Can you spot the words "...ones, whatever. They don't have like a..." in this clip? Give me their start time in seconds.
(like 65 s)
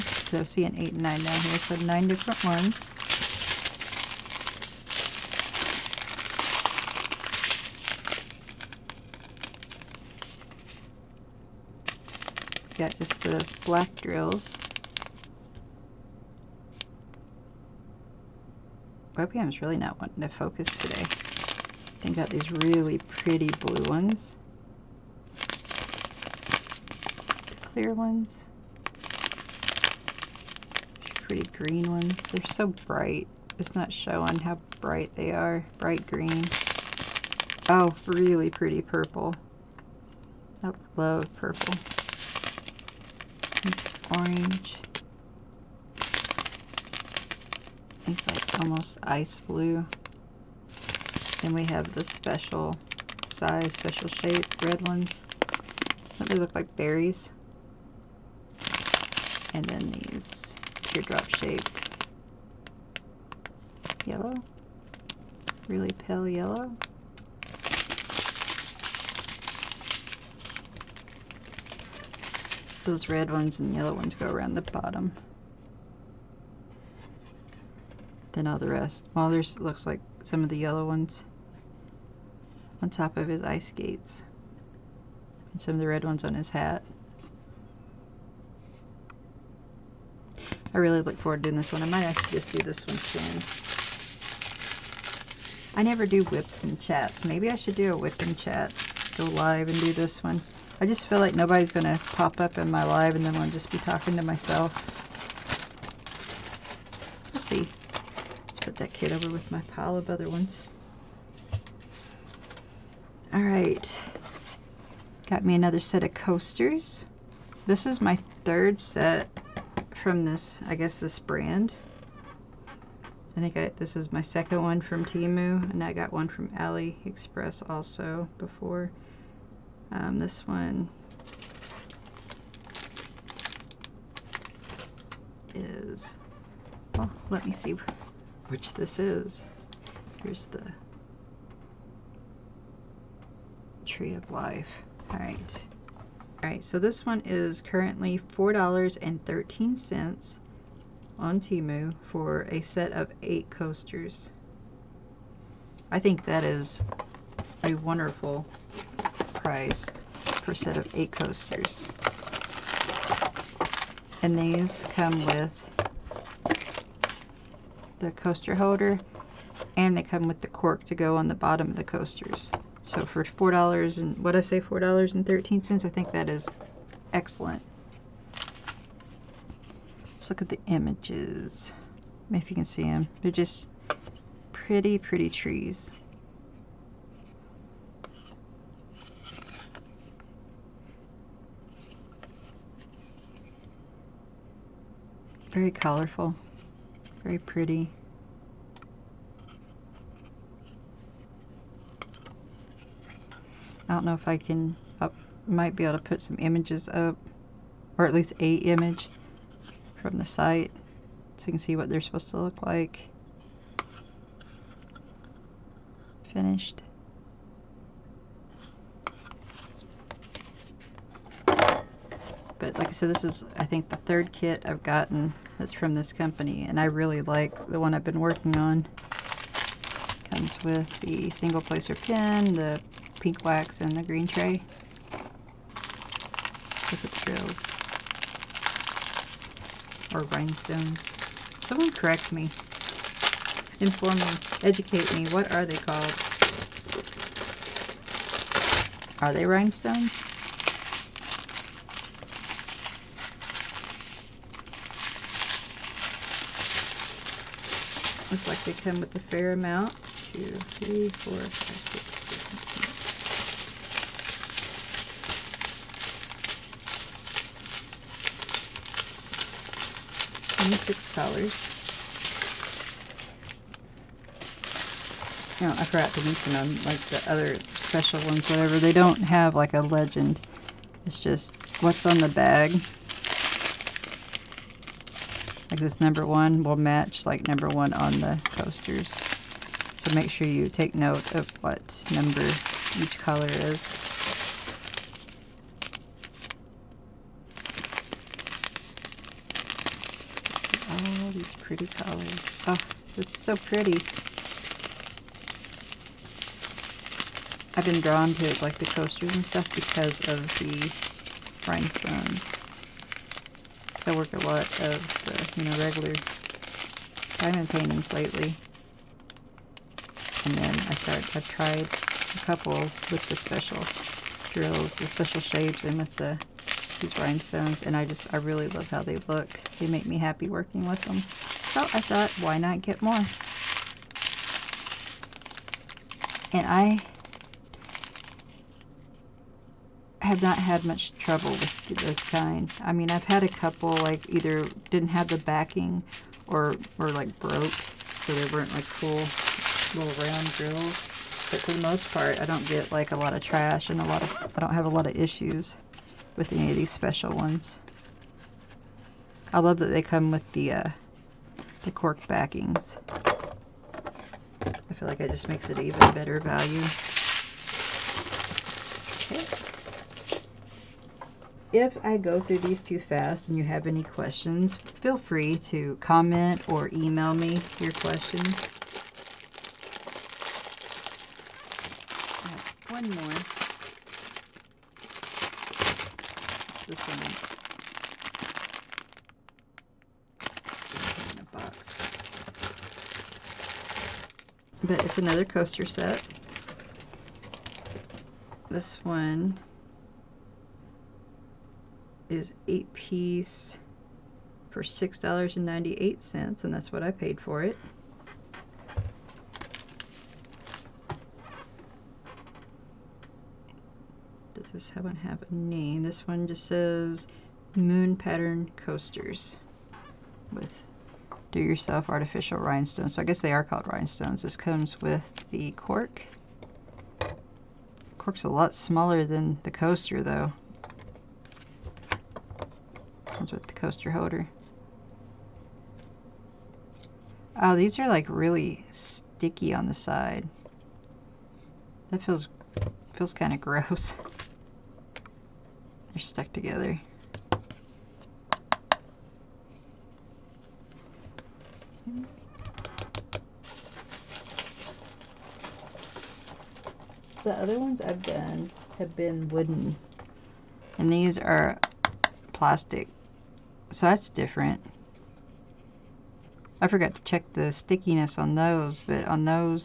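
278 s.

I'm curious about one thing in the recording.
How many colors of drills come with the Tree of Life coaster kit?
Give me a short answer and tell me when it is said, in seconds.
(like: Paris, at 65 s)
26, at 270 s.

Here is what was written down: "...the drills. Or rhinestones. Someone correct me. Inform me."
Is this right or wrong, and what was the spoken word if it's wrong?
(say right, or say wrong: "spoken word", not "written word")
right.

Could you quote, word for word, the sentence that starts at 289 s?
So make sure you take note of what number each color is.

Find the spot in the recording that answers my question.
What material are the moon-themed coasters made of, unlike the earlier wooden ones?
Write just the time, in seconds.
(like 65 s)
462 s.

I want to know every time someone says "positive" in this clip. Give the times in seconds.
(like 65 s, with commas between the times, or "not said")
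not said.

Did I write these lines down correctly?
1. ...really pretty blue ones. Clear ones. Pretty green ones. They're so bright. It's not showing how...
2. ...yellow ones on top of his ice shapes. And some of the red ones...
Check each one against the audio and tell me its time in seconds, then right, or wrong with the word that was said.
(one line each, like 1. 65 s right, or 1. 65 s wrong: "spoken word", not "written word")
1. 22 s right
2. 80 s wrong: "skates", not "shapes".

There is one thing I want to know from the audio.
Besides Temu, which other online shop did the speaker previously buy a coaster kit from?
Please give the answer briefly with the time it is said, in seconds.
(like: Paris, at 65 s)
AliExpress, at 126 s.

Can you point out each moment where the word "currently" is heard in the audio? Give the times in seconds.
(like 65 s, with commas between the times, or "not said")
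147 s.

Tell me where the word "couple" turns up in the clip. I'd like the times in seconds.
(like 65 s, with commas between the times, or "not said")
322 s, 343 s.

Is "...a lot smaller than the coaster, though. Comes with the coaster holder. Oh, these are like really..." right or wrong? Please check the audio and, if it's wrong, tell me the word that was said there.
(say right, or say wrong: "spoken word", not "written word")
right.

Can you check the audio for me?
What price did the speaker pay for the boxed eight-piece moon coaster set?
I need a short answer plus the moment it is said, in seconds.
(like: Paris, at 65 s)
$6.98, at 404 s.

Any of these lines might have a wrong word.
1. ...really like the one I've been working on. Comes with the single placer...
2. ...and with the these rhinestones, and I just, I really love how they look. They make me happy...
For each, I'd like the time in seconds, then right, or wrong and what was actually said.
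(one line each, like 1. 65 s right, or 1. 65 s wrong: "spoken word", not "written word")
1. 226 s right
2. 325 s right.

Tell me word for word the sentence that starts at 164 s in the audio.
And these come with the coaster holder and they come with the cork to go on the bottom of the coasters.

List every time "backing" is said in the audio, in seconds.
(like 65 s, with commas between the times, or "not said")
345 s, 362 s.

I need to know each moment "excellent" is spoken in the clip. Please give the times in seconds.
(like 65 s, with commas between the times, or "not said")
177 s.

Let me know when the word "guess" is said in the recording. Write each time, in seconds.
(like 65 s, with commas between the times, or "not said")
120 s, 423 s.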